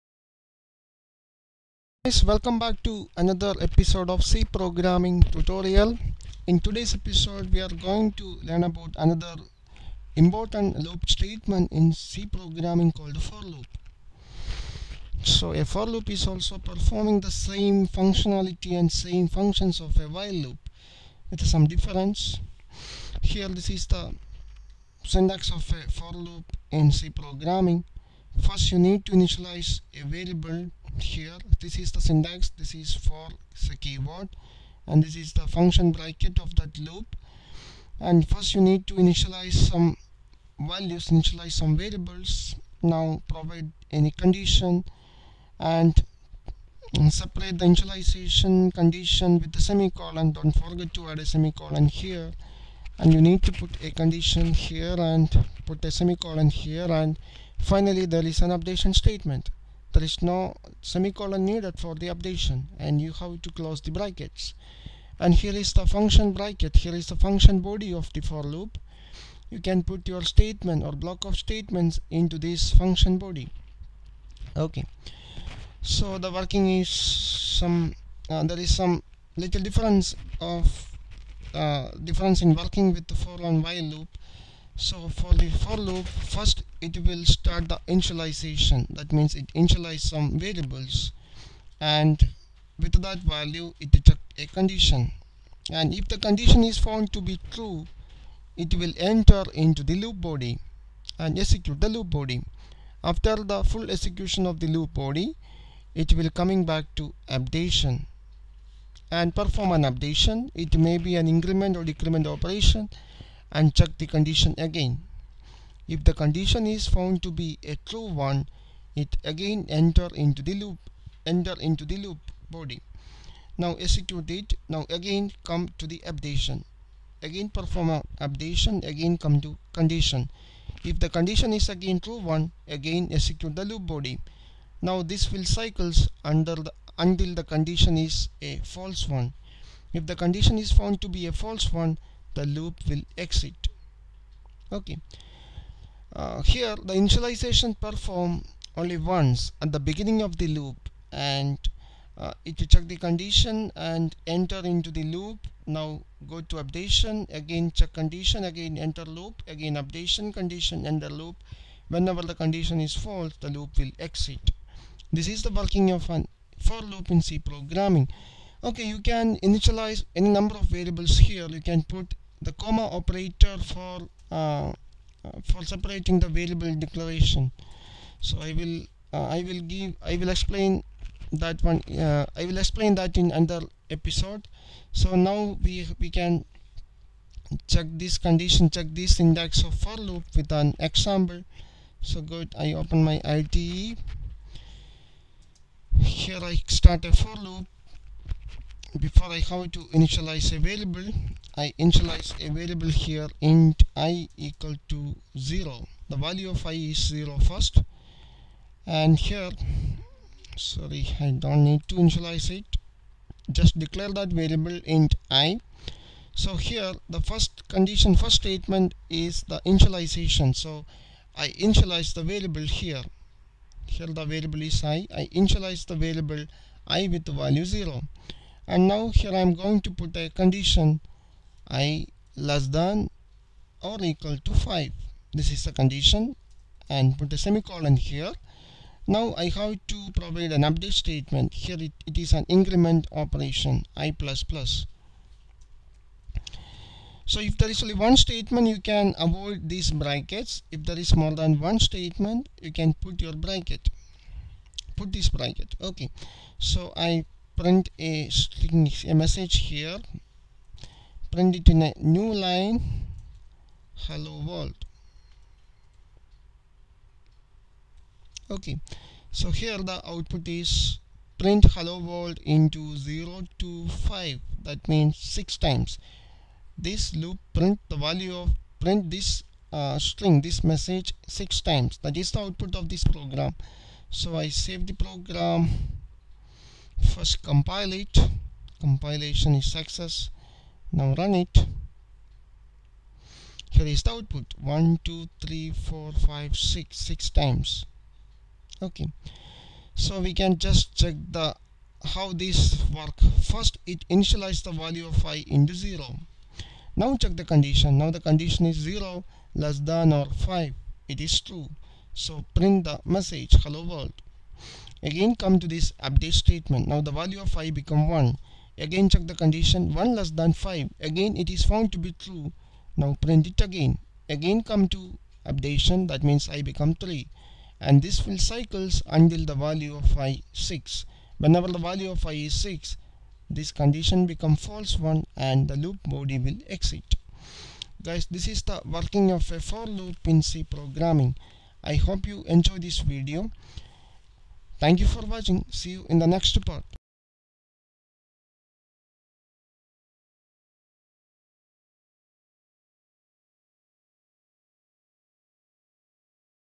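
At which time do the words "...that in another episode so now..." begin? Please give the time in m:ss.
3:02.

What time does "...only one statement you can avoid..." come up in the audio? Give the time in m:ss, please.
4:07.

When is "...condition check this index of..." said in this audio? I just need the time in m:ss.
3:08.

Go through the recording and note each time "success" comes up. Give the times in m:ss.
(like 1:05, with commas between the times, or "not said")
4:49.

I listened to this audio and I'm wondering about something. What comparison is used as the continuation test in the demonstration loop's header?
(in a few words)
i less than or equal to 5.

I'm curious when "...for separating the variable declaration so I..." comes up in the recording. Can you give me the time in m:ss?
2:55.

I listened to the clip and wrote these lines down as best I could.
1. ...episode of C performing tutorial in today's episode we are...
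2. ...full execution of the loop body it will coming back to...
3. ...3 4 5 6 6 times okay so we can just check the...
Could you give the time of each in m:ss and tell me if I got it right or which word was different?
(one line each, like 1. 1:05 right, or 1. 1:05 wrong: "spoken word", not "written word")
1. 0:03 wrong: "programming", not "performing"
2. 1:43 right
3. 4:55 right.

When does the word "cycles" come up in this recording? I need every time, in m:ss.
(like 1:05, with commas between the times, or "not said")
2:15, 5:28.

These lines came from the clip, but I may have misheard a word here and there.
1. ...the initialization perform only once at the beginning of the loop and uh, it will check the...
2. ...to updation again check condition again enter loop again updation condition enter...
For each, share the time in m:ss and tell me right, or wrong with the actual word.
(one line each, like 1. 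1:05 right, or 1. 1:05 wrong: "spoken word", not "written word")
1. 2:26 right
2. 2:36 right.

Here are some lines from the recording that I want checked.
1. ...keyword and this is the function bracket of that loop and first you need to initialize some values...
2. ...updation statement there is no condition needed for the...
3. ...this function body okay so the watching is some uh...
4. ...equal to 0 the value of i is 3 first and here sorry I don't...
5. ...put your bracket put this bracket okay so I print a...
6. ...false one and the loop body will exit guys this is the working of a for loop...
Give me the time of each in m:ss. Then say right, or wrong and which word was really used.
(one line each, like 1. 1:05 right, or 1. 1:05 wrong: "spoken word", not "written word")
1. 0:33 right
2. 0:58 wrong: "semicolon", not "condition"
3. 1:12 wrong: "working", not "watching"
4. 3:24 wrong: "0", not "3"
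5. 4:12 right
6. 5:34 right.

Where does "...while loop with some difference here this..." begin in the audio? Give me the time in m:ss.
0:20.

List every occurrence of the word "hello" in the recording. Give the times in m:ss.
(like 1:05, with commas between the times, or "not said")
4:24, 4:31, 5:13.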